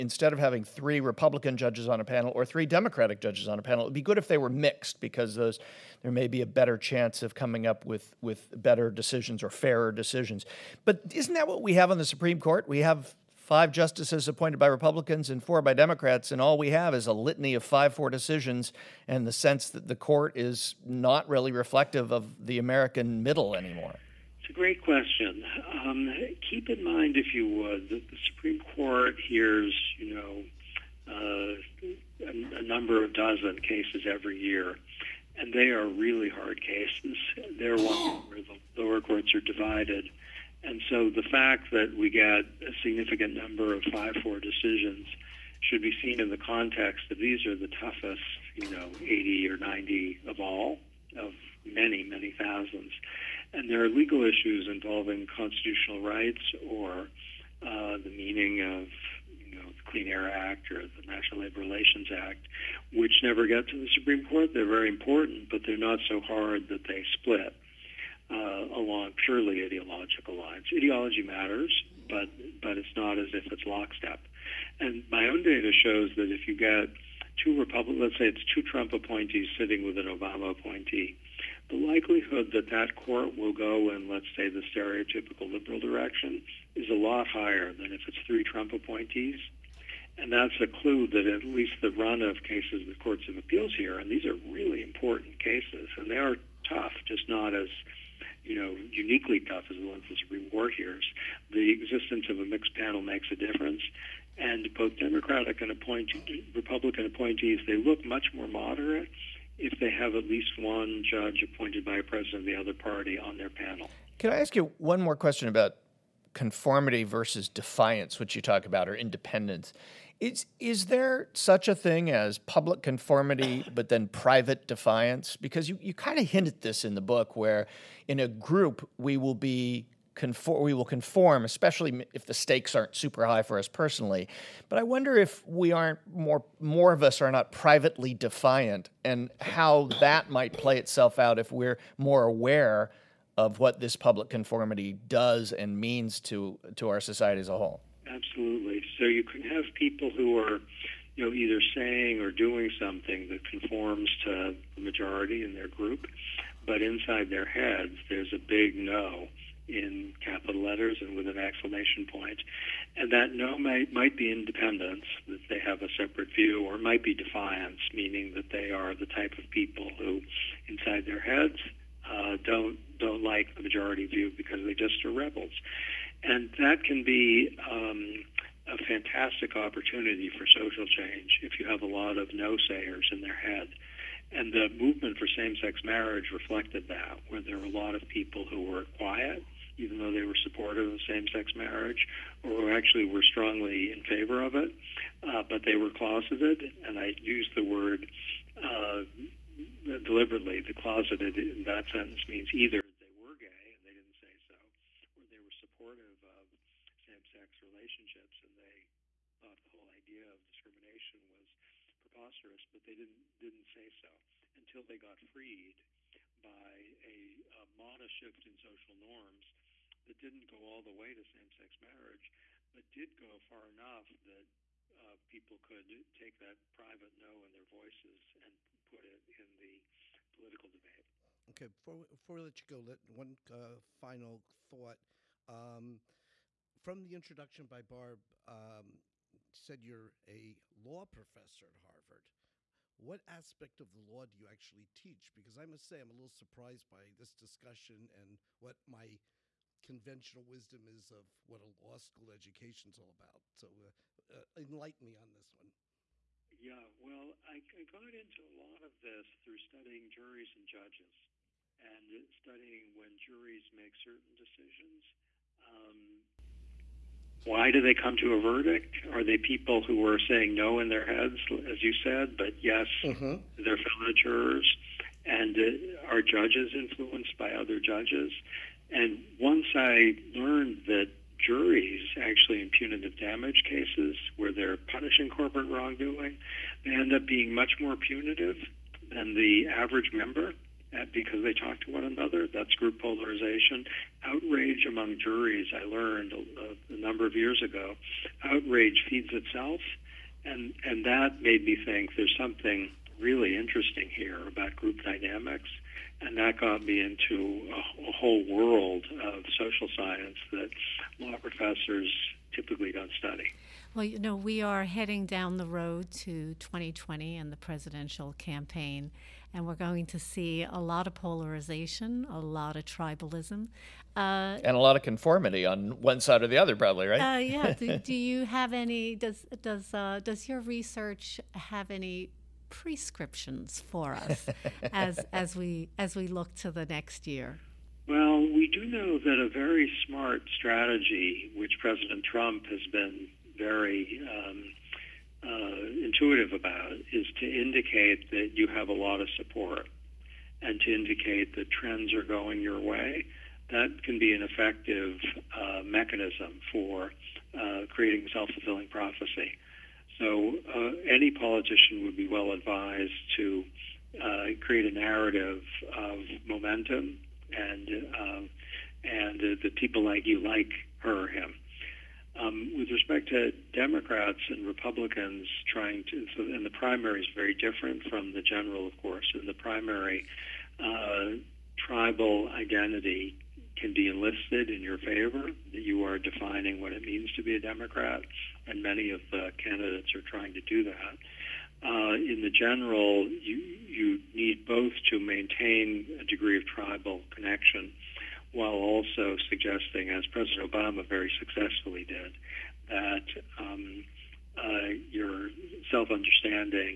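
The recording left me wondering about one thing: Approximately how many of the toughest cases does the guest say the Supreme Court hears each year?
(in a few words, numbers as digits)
80 or 90.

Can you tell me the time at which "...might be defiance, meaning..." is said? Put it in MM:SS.
02:46.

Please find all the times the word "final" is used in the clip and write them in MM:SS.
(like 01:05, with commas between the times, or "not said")
03:53.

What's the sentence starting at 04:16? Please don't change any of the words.
Yeah, well, I, I got into a lot of this through studying juries and judges and studying when juries make certain decisions.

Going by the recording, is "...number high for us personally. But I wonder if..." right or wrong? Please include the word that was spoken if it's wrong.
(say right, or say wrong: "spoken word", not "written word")
wrong: "super", not "number".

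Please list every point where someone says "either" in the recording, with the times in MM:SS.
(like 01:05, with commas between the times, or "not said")
02:31, 03:22.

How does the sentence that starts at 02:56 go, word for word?
And that can be um, a fantastic opportunity for social change if you have a lot of no-sayers in their head.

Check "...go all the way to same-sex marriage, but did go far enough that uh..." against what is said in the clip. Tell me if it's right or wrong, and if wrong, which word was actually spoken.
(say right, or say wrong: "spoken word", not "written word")
right.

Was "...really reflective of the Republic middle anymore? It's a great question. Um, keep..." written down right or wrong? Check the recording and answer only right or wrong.
wrong.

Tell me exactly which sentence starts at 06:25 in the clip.
You are defining what it means to be a Democrat, and many of the candidates are trying to do that.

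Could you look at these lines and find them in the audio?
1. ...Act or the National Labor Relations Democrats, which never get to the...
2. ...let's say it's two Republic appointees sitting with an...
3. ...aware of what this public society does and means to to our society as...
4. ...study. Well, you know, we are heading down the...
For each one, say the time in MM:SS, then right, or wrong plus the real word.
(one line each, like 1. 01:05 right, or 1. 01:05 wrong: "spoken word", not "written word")
1. 01:00 wrong: "Act", not "Democrats"
2. 01:17 wrong: "Trump", not "Republic"
3. 02:22 wrong: "conformity", not "society"
4. 05:13 right.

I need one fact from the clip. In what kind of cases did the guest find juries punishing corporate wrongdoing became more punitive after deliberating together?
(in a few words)
punitive damage cases.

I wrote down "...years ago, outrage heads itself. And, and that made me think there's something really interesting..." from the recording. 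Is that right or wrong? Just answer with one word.
wrong.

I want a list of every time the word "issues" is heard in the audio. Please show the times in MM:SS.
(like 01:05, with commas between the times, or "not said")
00:54.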